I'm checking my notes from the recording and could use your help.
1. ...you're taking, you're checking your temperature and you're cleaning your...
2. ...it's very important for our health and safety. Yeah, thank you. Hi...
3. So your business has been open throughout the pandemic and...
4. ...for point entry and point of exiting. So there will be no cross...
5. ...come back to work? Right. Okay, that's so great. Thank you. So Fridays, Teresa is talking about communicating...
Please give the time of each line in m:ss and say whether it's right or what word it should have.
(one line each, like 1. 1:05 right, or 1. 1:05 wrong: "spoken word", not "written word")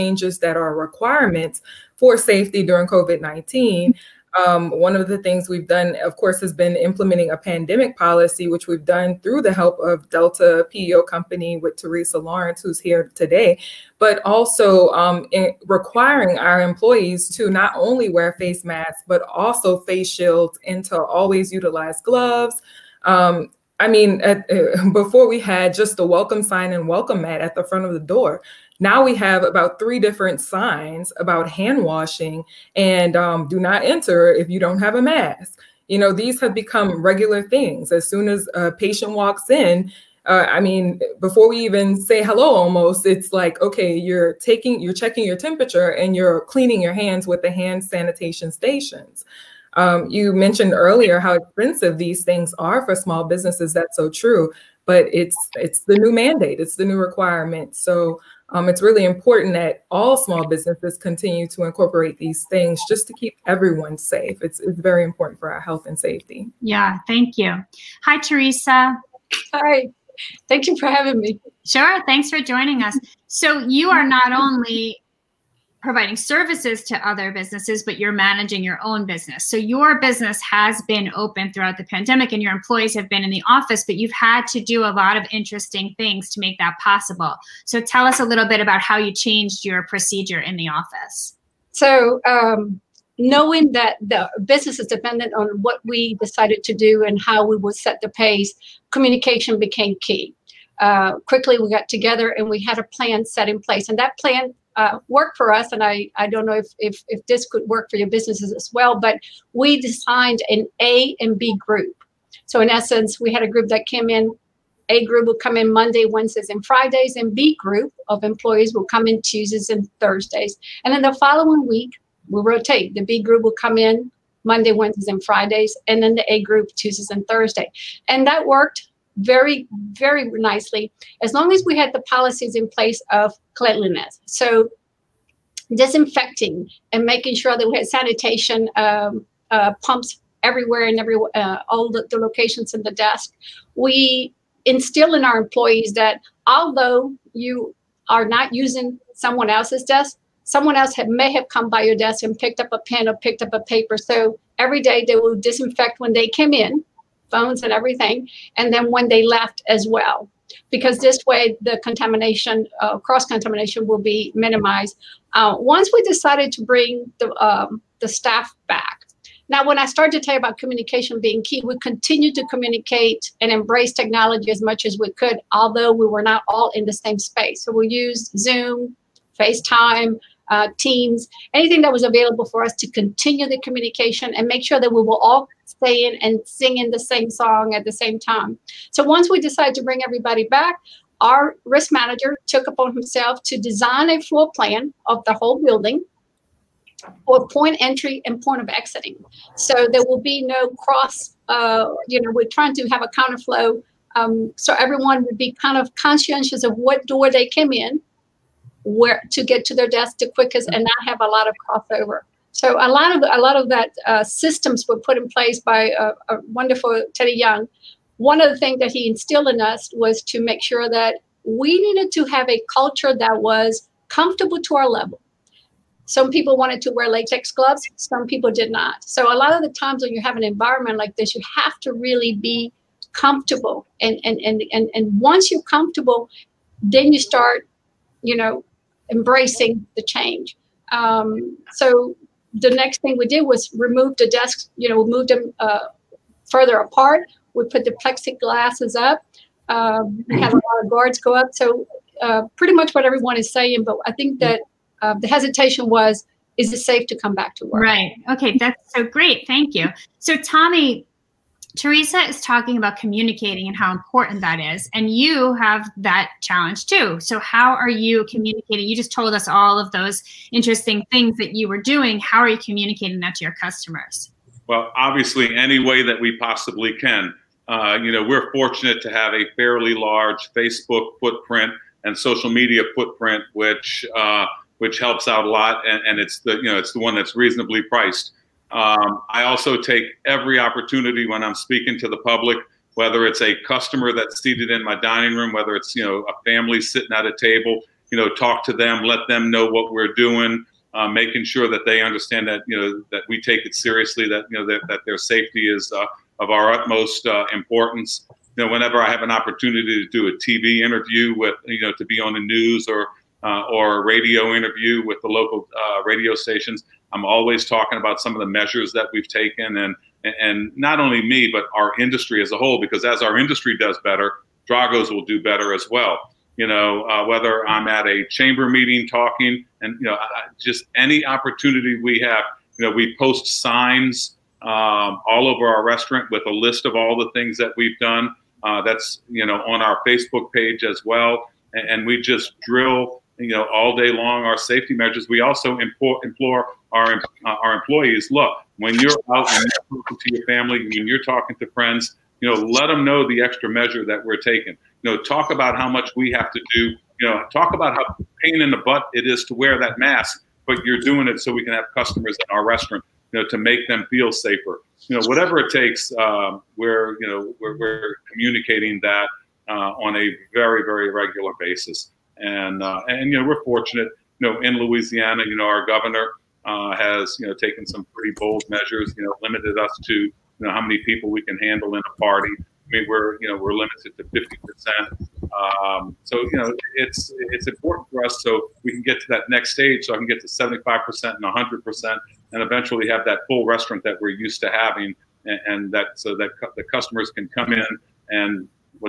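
1. 0:43 right
2. 1:04 right
3. 1:19 right
4. 3:17 right
5. 4:17 wrong: "Tommy", not "Fridays".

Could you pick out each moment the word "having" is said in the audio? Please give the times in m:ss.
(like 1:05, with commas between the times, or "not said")
1:10, 6:34.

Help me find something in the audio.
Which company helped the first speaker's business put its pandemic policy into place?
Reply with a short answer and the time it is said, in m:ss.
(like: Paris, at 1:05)
Delta PEO Company, at 0:10.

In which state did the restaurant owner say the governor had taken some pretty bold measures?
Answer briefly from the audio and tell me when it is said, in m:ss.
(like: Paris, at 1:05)
Louisiana, at 6:14.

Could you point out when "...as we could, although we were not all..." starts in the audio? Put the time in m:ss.
2:54.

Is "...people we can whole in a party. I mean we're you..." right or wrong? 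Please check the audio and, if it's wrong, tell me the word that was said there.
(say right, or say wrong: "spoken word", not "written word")
wrong: "handle", not "whole".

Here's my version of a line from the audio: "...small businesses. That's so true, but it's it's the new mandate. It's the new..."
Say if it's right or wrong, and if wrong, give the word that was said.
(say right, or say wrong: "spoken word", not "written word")
right.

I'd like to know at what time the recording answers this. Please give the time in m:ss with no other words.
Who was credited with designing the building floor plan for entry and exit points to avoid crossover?
3:37.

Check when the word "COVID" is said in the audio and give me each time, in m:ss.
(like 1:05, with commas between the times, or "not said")
0:02.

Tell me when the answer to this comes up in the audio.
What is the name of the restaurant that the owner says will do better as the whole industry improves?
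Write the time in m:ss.
5:24.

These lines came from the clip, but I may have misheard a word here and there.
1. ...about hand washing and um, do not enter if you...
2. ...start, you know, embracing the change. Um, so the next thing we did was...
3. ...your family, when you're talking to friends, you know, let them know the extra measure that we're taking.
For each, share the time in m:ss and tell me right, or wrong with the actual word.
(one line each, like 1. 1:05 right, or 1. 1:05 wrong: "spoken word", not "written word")
1. 0:31 right
2. 3:57 right
3. 5:50 right.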